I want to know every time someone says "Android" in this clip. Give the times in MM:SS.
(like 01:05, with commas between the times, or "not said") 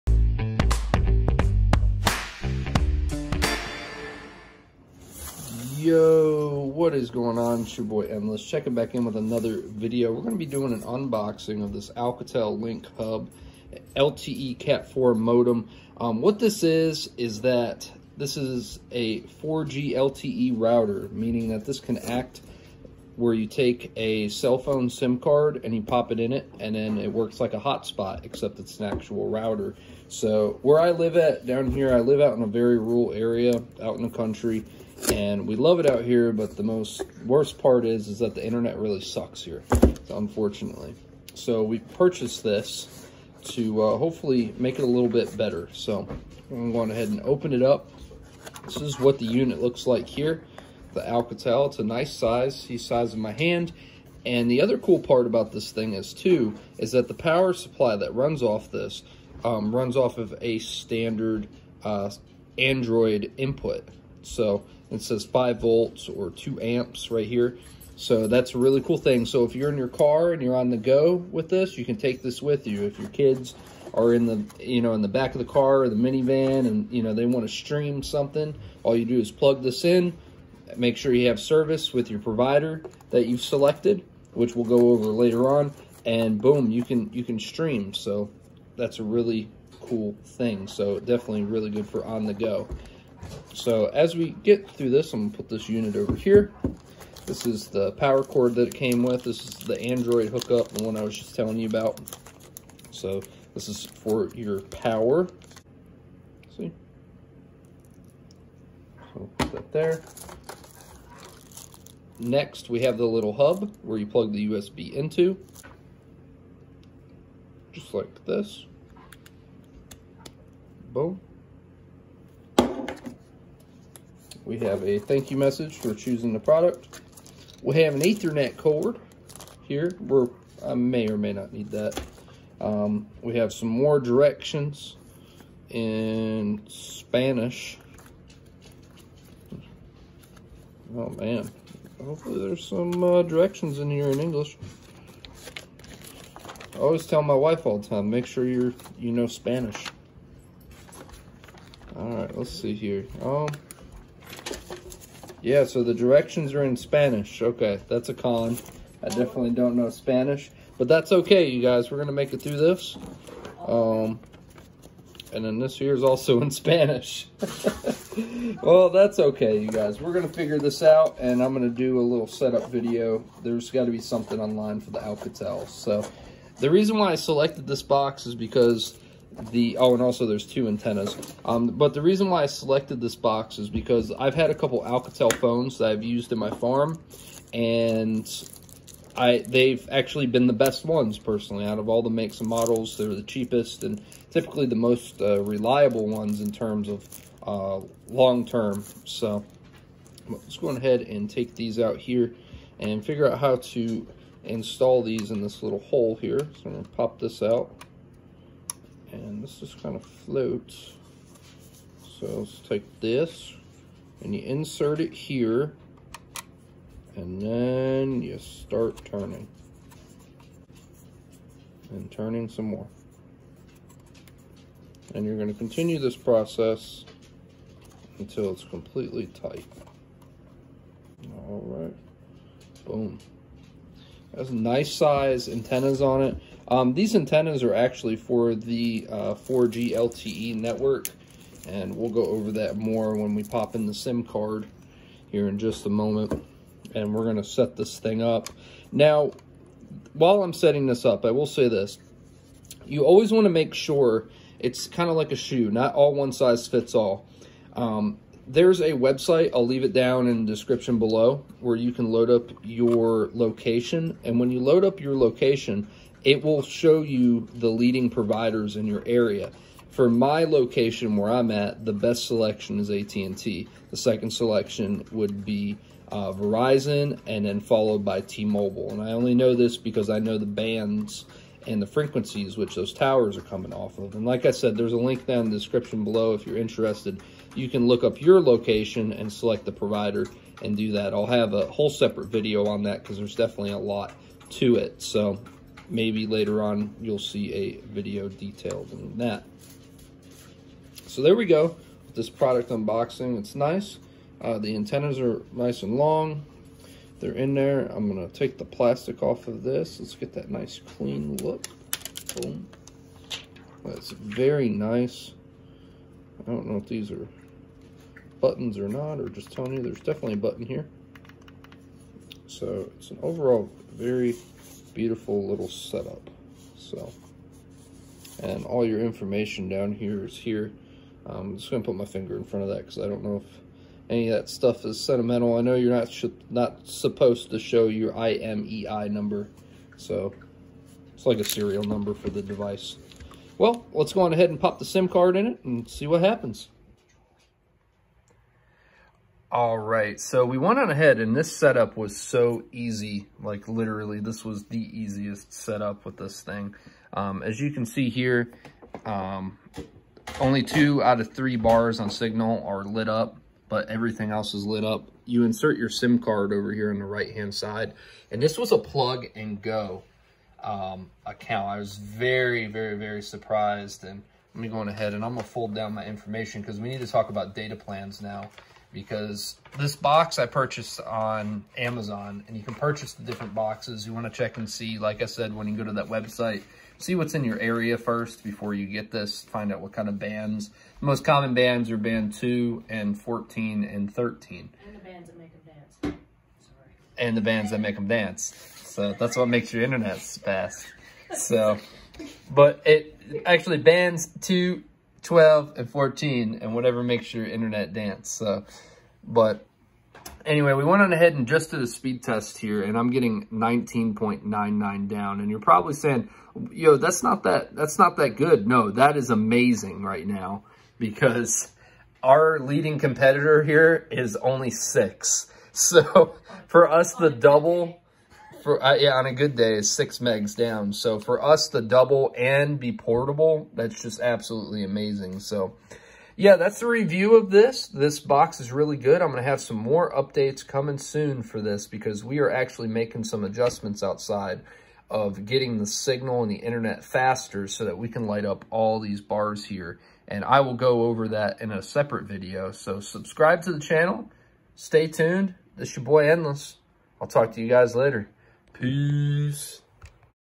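01:02, 01:39.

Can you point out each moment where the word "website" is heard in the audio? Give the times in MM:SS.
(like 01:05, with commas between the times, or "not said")
04:18, 06:26.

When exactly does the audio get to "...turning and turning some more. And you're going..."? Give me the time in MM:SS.
03:39.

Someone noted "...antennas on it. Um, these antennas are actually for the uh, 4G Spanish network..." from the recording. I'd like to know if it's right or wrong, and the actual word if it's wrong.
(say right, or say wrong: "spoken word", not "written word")
wrong: "LTE", not "Spanish".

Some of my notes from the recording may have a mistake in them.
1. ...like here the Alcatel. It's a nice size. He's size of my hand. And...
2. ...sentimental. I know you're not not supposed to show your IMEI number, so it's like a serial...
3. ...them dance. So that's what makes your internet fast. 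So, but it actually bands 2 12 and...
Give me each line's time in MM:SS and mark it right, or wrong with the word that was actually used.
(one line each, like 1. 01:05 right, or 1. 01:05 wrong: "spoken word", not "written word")
1. 00:49 right
2. 05:34 right
3. 06:37 right.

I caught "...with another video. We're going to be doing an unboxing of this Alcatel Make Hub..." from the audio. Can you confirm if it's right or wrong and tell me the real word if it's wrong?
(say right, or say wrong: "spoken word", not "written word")
wrong: "Link", not "Make".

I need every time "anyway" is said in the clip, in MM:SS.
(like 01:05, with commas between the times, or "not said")
06:50.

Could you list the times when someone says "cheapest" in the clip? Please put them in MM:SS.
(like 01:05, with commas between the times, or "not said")
03:13.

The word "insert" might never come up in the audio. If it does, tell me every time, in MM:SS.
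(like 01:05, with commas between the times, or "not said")
03:34, 06:05.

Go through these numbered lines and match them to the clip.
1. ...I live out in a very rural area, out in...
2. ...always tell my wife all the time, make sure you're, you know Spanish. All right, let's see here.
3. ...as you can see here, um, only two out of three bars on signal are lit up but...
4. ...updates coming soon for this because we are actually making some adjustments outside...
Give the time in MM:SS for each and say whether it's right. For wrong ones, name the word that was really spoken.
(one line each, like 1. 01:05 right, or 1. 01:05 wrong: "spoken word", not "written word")
1. 00:31 right
2. 02:26 right
3. 05:57 right
4. 07:20 right.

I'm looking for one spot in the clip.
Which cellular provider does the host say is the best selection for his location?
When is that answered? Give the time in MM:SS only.
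04:32.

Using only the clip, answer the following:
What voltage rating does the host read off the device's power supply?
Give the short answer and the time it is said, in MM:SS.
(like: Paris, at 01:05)
5 volts, at 01:05.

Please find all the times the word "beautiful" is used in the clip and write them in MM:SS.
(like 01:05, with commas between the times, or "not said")
05:24.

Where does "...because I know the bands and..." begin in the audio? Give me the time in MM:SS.
04:39.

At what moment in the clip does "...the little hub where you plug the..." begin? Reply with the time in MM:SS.
01:52.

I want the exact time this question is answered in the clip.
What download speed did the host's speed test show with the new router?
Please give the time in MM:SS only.
06:53.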